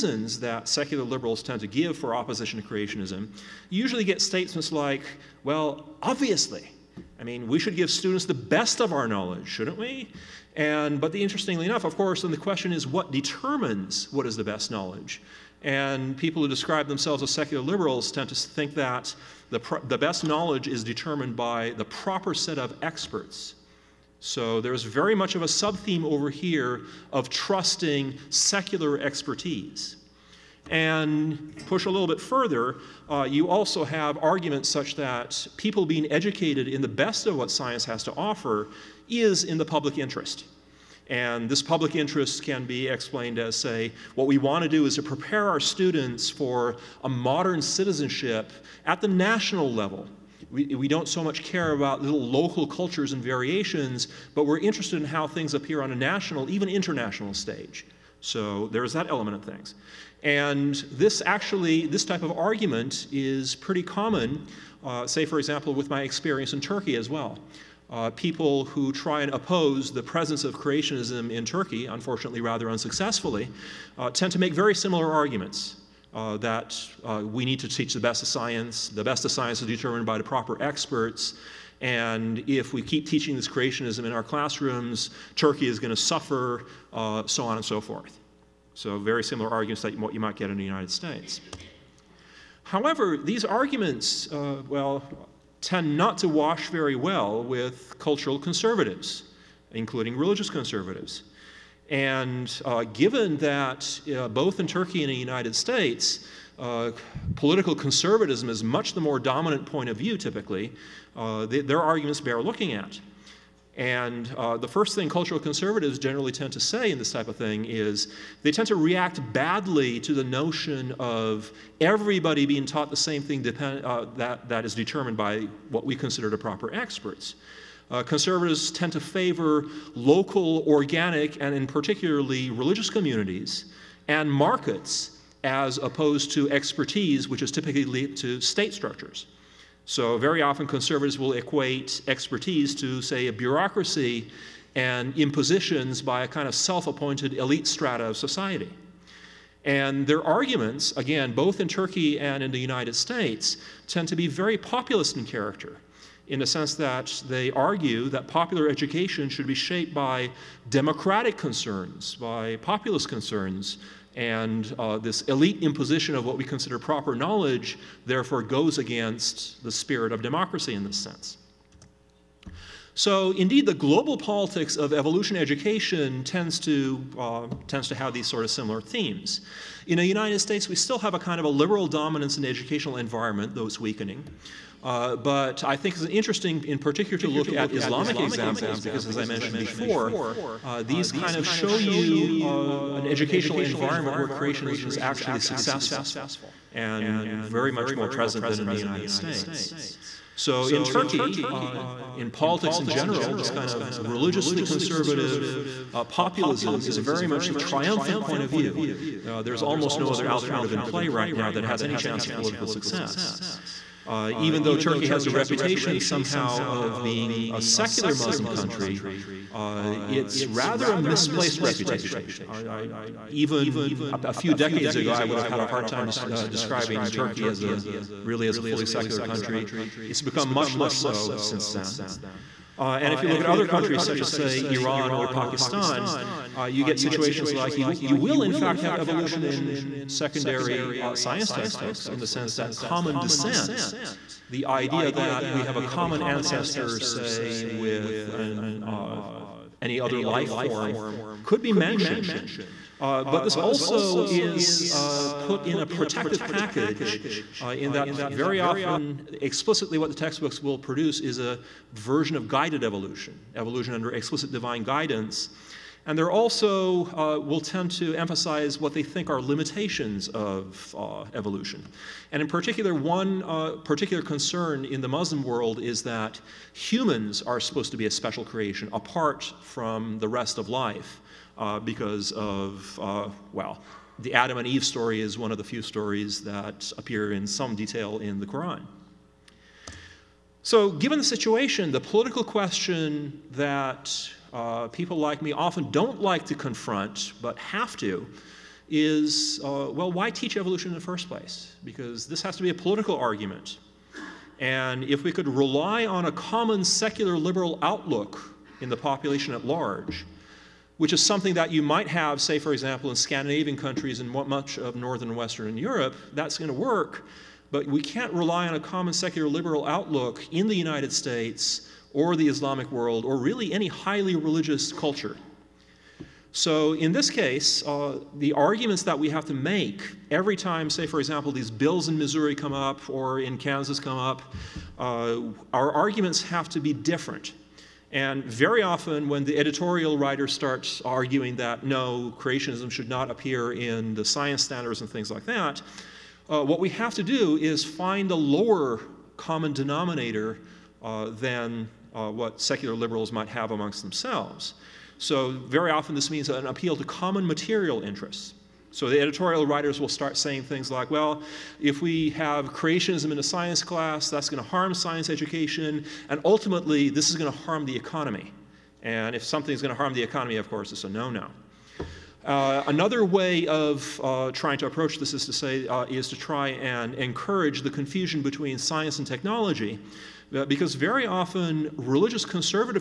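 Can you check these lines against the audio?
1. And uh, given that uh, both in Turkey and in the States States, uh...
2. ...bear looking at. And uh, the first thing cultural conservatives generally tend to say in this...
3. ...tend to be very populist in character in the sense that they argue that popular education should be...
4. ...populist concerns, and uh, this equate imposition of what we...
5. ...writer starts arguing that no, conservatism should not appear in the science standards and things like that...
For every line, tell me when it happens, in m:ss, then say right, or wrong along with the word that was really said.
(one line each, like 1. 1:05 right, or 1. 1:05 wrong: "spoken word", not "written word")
1. 1:41 wrong: "United", not "States"
2. 1:52 right
3. 2:33 right
4. 2:42 wrong: "elite", not "equate"
5. 5:40 wrong: "creationism", not "conservatism".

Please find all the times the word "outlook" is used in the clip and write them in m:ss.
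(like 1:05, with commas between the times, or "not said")
5:07, 5:19.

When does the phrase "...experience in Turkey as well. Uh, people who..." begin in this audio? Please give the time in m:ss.
1:06.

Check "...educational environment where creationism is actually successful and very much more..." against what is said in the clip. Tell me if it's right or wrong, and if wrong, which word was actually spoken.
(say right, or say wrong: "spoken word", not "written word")
right.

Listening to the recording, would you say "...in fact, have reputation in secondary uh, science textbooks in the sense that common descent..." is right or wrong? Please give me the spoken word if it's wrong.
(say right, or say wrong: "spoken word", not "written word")
wrong: "evolution", not "reputation".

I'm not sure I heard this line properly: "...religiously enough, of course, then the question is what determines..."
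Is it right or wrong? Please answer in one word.
wrong.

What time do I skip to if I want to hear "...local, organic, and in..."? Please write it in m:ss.
2:09.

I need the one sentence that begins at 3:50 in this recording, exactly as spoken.
It's become much less so since then.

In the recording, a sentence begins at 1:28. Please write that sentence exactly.
So, very similar arguments that what you might get in the United States.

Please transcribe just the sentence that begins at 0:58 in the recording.
So there is that element of things.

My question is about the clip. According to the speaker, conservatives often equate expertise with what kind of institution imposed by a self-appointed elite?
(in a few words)
a bureaucracy.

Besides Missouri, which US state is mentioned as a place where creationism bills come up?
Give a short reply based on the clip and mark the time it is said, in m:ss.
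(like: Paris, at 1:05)
Kansas, at 5:33.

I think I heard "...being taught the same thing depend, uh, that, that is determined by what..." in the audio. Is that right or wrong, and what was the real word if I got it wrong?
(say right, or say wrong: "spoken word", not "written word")
right.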